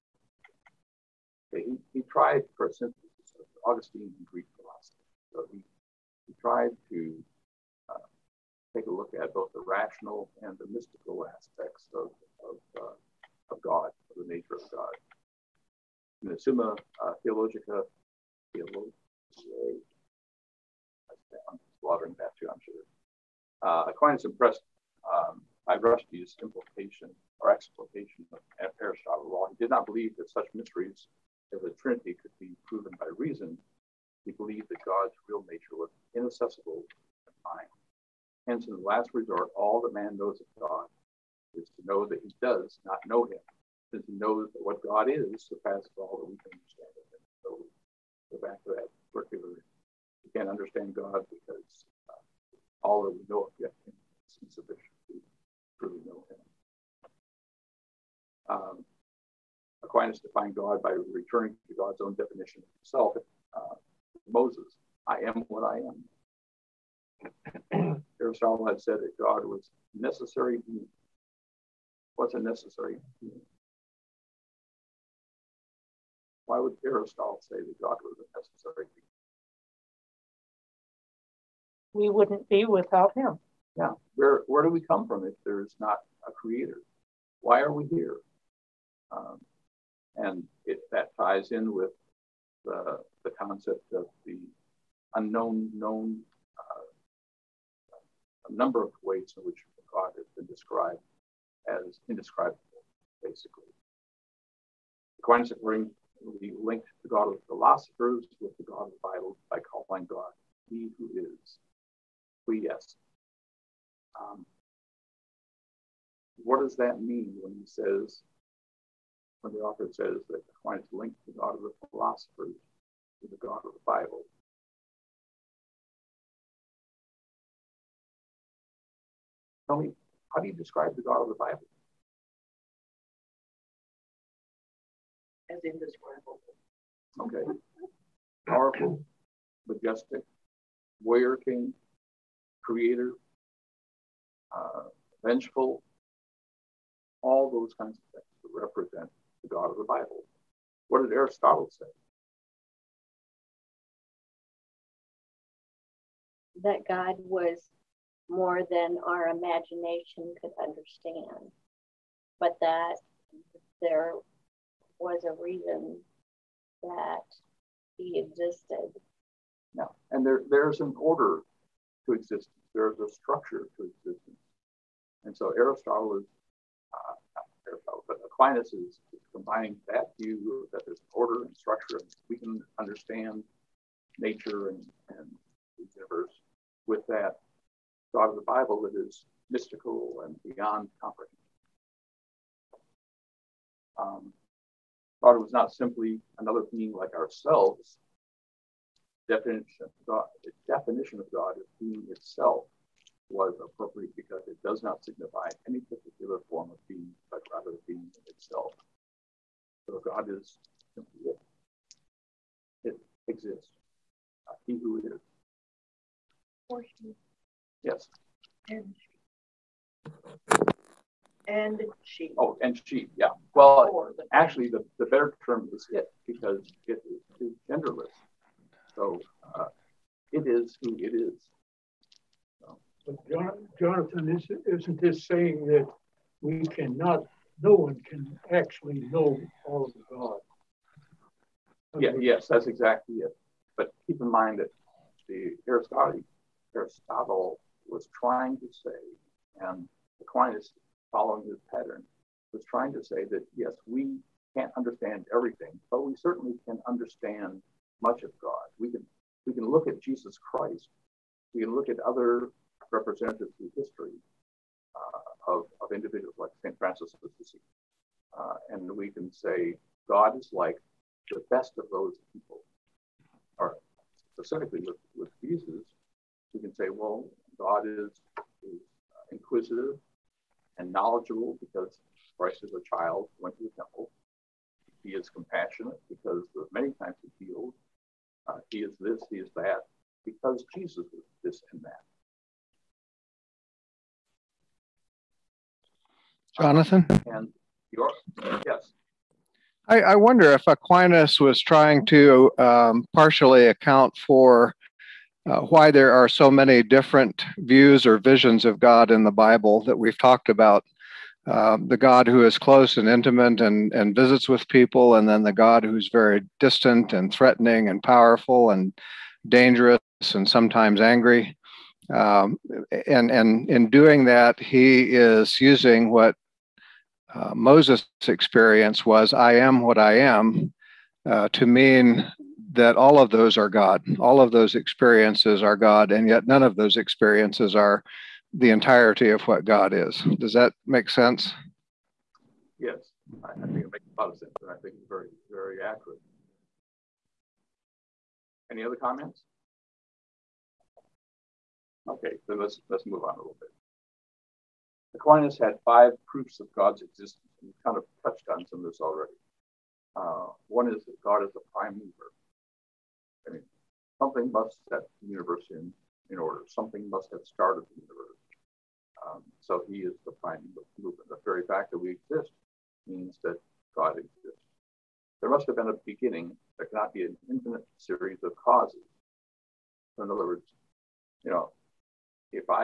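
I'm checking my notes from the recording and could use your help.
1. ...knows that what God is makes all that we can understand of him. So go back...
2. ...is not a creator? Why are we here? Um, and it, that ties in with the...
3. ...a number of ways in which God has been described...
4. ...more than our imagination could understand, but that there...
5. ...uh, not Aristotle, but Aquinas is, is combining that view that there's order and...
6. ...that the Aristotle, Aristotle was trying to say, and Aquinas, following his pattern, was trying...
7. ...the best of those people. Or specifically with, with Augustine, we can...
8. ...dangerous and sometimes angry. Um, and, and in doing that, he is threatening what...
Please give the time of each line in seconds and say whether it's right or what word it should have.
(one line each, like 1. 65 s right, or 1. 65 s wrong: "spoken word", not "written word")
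1. 44 s wrong: "surpasses", not "makes"
2. 85 s right
3. 98 s right
4. 158 s right
5. 176 s right
6. 244 s right
7. 271 s wrong: "Jesus", not "Augustine"
8. 319 s wrong: "using", not "threatening".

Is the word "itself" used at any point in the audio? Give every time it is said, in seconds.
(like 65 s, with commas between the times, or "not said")
202 s, 208 s.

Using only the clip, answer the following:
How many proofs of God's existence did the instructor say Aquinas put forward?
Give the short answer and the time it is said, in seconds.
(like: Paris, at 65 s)
5, at 355 s.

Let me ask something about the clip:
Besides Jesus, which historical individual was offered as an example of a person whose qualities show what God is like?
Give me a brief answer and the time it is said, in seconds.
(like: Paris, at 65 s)
St. Francis of Assisi, at 266 s.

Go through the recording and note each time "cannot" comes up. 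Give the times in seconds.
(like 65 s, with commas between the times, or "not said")
236 s, 376 s.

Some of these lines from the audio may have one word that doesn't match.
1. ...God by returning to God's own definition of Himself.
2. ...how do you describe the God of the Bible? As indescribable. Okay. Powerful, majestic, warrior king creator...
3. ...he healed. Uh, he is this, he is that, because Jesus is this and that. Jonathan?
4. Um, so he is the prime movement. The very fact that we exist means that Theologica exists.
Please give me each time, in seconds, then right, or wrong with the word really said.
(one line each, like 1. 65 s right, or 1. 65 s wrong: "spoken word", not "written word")
1. 60 s right
2. 130 s right
3. 287 s right
4. 369 s wrong: "God", not "Theologica".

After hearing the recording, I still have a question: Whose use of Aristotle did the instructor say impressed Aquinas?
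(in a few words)
Rushdie.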